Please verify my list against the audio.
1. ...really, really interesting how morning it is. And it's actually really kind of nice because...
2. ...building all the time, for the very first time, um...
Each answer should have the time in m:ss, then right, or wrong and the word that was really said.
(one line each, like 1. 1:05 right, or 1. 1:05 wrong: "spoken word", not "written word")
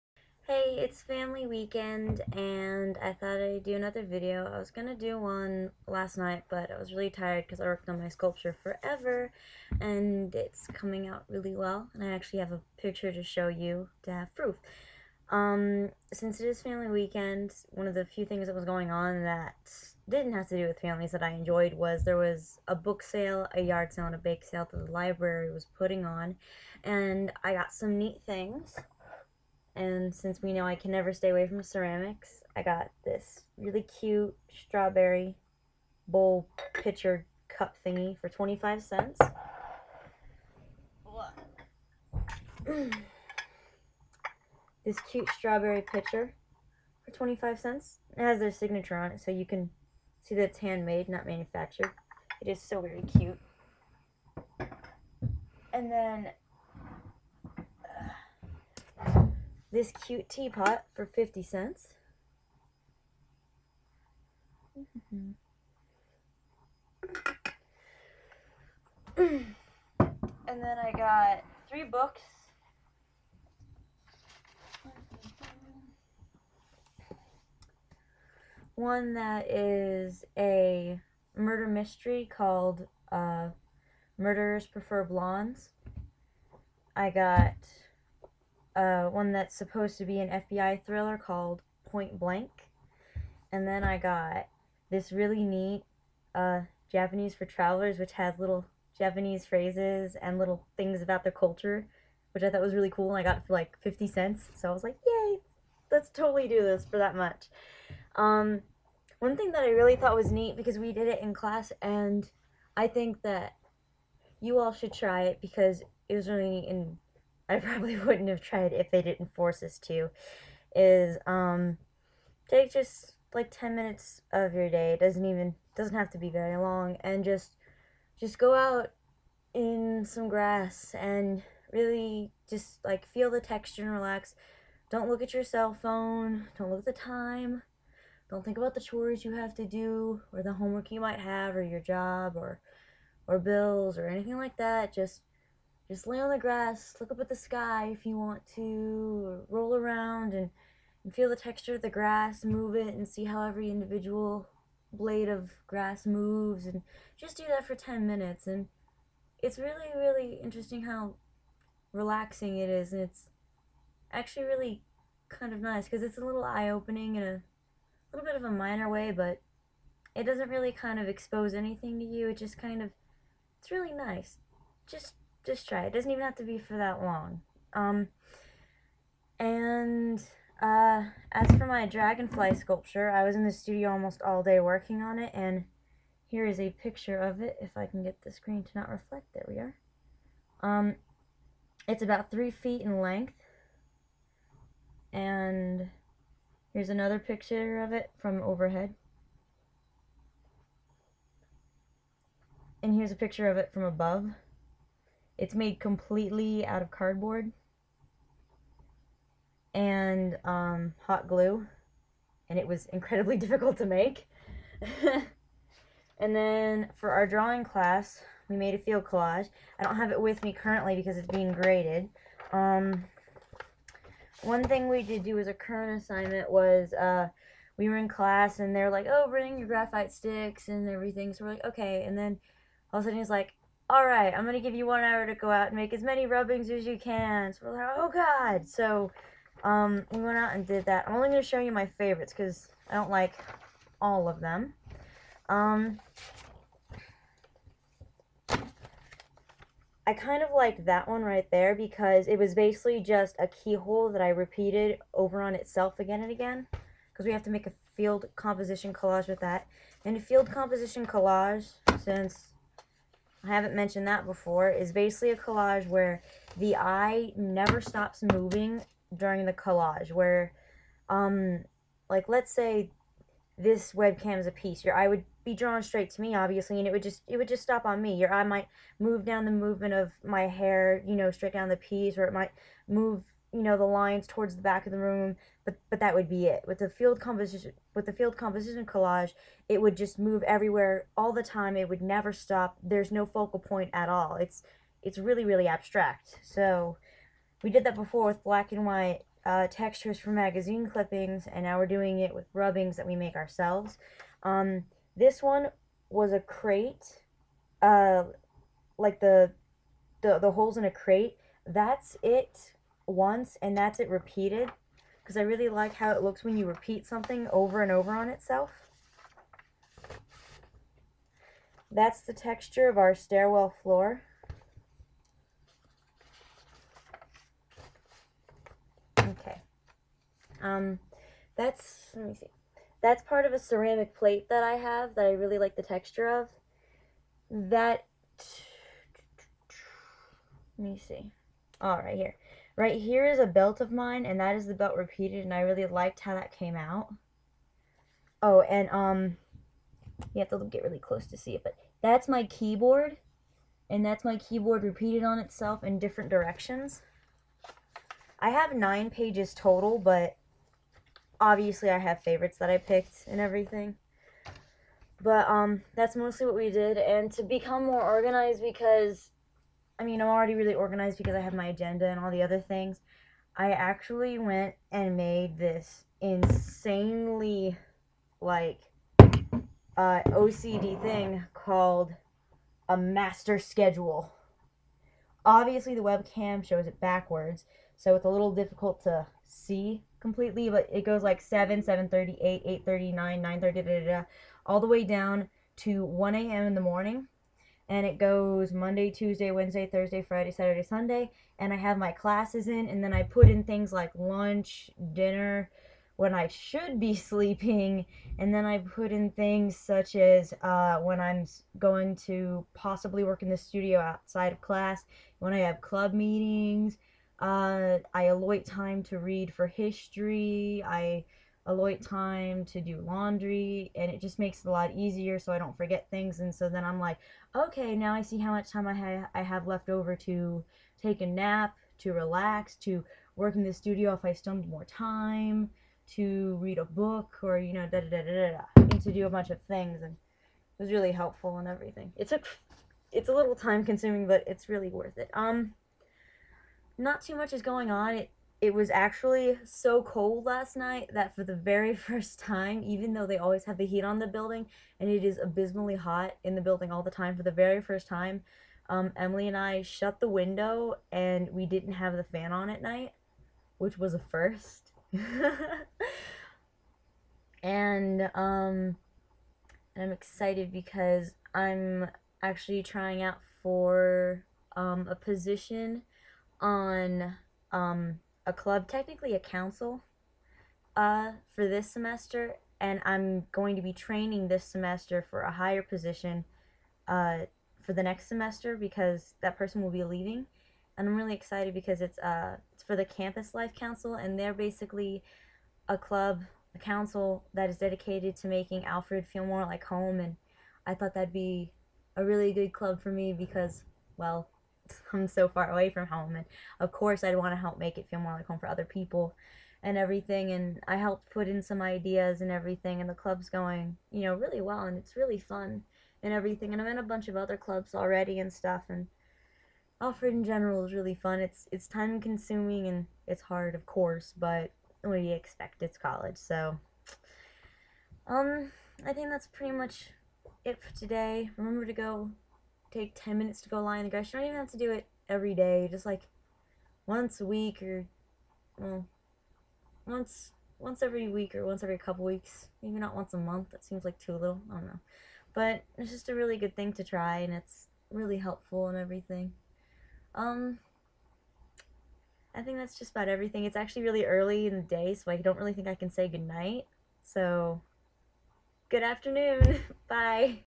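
1. 2:39 wrong: "relaxing", not "morning"
2. 7:36 right.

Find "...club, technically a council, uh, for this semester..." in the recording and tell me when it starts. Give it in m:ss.
7:58.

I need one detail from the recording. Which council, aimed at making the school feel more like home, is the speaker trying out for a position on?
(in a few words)
Campus Life Council.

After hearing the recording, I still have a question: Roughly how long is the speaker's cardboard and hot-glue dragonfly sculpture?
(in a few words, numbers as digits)
3 feet.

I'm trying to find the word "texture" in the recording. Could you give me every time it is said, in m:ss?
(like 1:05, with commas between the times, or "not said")
2:13, 2:31, 4:59, 5:22, 5:35.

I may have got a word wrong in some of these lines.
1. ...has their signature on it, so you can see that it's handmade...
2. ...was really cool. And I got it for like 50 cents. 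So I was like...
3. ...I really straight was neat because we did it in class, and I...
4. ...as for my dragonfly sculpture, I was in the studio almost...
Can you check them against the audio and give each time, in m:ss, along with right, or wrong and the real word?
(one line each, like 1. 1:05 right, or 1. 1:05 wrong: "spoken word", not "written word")
1. 0:48 right
2. 1:42 right
3. 1:49 wrong: "thought", not "straight"
4. 3:01 right.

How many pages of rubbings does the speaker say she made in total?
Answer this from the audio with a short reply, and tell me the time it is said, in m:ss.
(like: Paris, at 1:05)
9, at 5:58.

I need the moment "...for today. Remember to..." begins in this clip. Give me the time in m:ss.
8:50.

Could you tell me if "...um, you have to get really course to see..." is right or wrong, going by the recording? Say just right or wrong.
wrong.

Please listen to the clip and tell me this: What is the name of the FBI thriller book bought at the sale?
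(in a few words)
Point Blank.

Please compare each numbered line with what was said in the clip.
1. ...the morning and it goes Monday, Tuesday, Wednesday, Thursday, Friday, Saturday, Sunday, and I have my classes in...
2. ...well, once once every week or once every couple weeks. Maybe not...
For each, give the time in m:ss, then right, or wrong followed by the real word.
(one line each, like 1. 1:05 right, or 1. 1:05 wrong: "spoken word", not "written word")
1. 6:36 right
2. 8:58 right.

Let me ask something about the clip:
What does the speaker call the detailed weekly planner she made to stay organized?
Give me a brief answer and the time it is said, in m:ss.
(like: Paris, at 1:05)
master schedule, at 6:22.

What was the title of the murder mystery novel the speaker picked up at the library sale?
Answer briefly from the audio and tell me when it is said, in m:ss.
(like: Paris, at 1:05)
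Murderers Prefer Blondes, at 1:24.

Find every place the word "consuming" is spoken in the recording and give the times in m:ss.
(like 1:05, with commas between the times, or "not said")
7:23, 8:42.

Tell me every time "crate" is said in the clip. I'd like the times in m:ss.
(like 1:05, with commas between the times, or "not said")
5:06, 5:10.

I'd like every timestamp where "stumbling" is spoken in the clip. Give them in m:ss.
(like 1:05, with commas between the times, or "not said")
not said.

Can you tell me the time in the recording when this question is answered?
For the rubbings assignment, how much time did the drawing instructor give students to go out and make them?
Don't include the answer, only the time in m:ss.
3:54.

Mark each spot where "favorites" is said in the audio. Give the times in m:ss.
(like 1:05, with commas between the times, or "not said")
4:01, 6:02.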